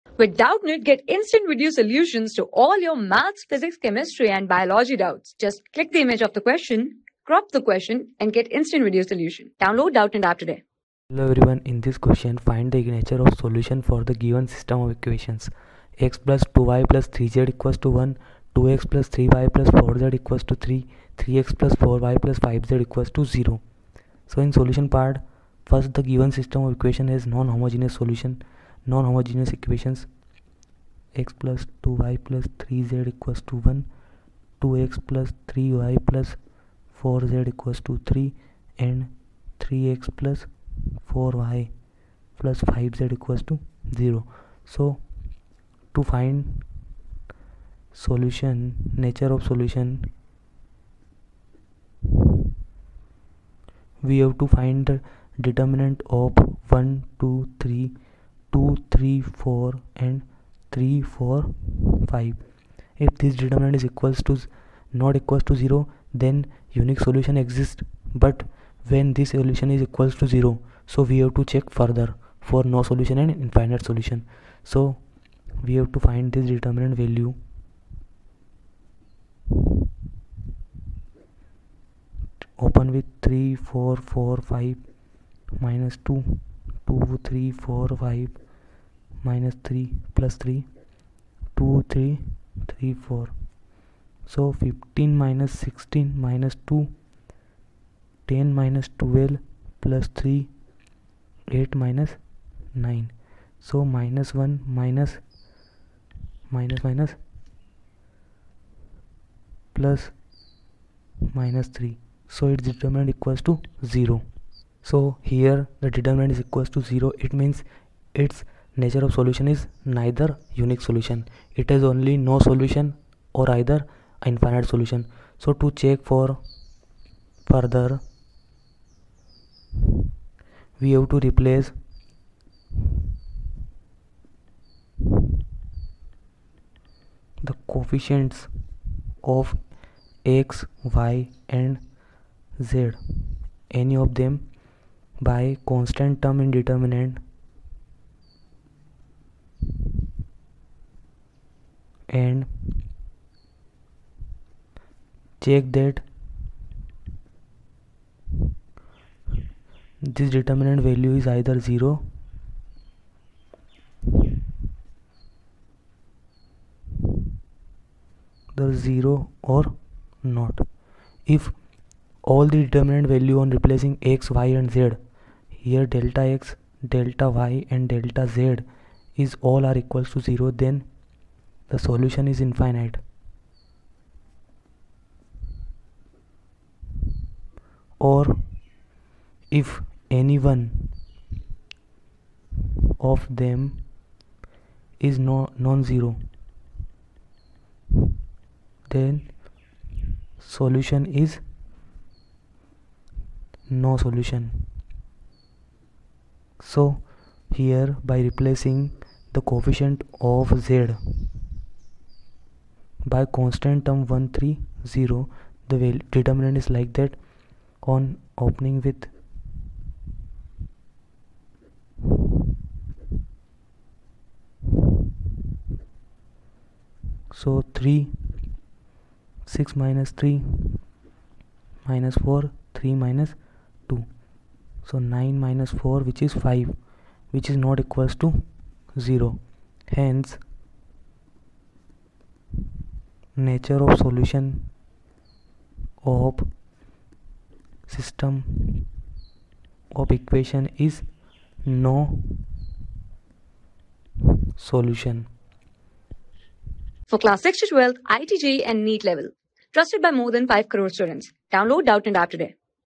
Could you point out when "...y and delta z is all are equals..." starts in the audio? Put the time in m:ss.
2:57.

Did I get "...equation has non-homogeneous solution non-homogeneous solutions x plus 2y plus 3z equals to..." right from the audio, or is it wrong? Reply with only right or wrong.
wrong.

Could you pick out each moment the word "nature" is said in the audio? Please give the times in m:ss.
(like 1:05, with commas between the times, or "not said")
0:12, 0:48, 1:58, 4:03.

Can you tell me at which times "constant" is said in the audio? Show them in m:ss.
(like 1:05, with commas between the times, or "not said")
2:25, 3:33.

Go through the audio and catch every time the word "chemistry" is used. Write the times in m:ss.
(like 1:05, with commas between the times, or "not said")
0:03.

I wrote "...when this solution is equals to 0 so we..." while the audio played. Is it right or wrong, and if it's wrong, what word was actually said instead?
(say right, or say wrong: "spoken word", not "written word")
right.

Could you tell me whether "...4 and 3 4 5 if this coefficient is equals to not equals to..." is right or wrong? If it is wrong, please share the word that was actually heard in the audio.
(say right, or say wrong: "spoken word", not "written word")
wrong: "determinant", not "coefficient".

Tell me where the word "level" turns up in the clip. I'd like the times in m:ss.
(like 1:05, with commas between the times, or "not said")
4:19.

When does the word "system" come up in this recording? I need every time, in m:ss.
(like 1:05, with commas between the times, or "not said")
0:14, 0:26, 4:07.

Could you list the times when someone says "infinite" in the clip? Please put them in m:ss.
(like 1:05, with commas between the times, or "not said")
1:13, 2:04, 3:02.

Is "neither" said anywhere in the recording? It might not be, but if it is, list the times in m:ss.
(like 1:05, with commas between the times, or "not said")
1:59.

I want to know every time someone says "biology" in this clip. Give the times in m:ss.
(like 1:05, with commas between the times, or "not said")
0:04.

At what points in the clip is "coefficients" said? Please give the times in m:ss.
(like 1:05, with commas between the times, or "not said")
2:17, 3:29.